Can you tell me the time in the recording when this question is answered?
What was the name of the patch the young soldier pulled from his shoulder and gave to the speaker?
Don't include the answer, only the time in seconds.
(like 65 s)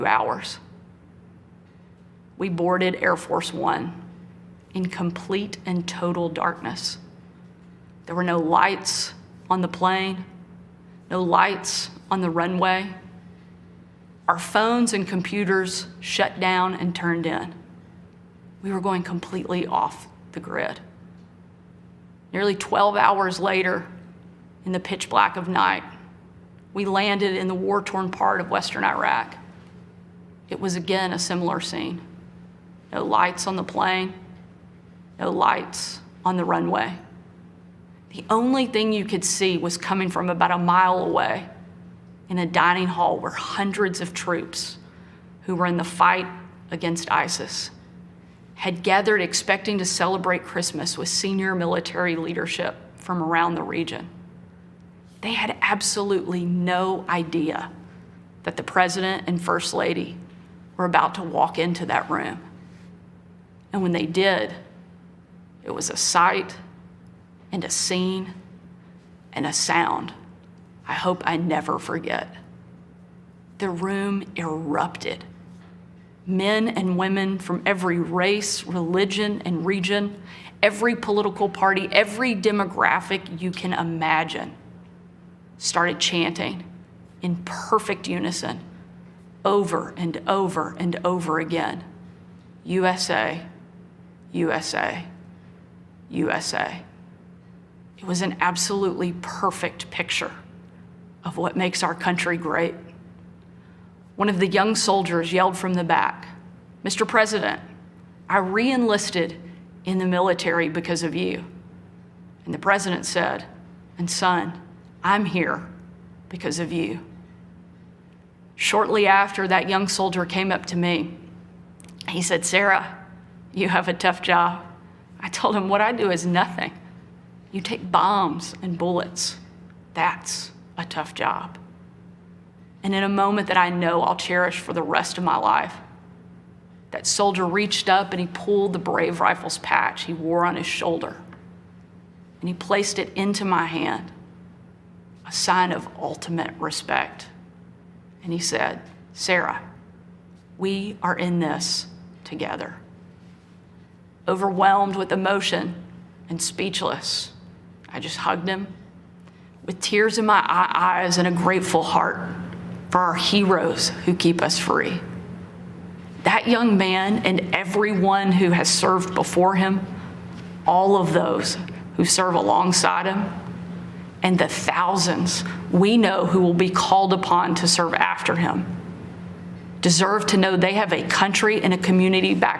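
138 s.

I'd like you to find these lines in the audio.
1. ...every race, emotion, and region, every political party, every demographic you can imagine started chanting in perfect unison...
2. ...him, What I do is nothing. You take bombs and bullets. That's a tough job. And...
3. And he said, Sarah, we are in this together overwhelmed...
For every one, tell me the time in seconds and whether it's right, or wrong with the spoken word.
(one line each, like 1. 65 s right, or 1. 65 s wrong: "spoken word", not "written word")
1. 77 s wrong: "religion", not "emotion"
2. 125 s right
3. 148 s right.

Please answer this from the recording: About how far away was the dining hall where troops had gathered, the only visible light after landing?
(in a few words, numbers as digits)
About a mile.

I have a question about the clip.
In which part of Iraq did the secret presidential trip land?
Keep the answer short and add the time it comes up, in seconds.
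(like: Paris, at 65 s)
Western Iraq, at 28 s.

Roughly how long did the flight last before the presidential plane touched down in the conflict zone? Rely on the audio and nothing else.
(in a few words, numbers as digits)
Nearly 12 hours.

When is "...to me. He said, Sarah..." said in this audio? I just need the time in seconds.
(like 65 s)
120 s.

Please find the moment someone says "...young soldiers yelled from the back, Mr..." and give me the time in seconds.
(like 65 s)
104 s.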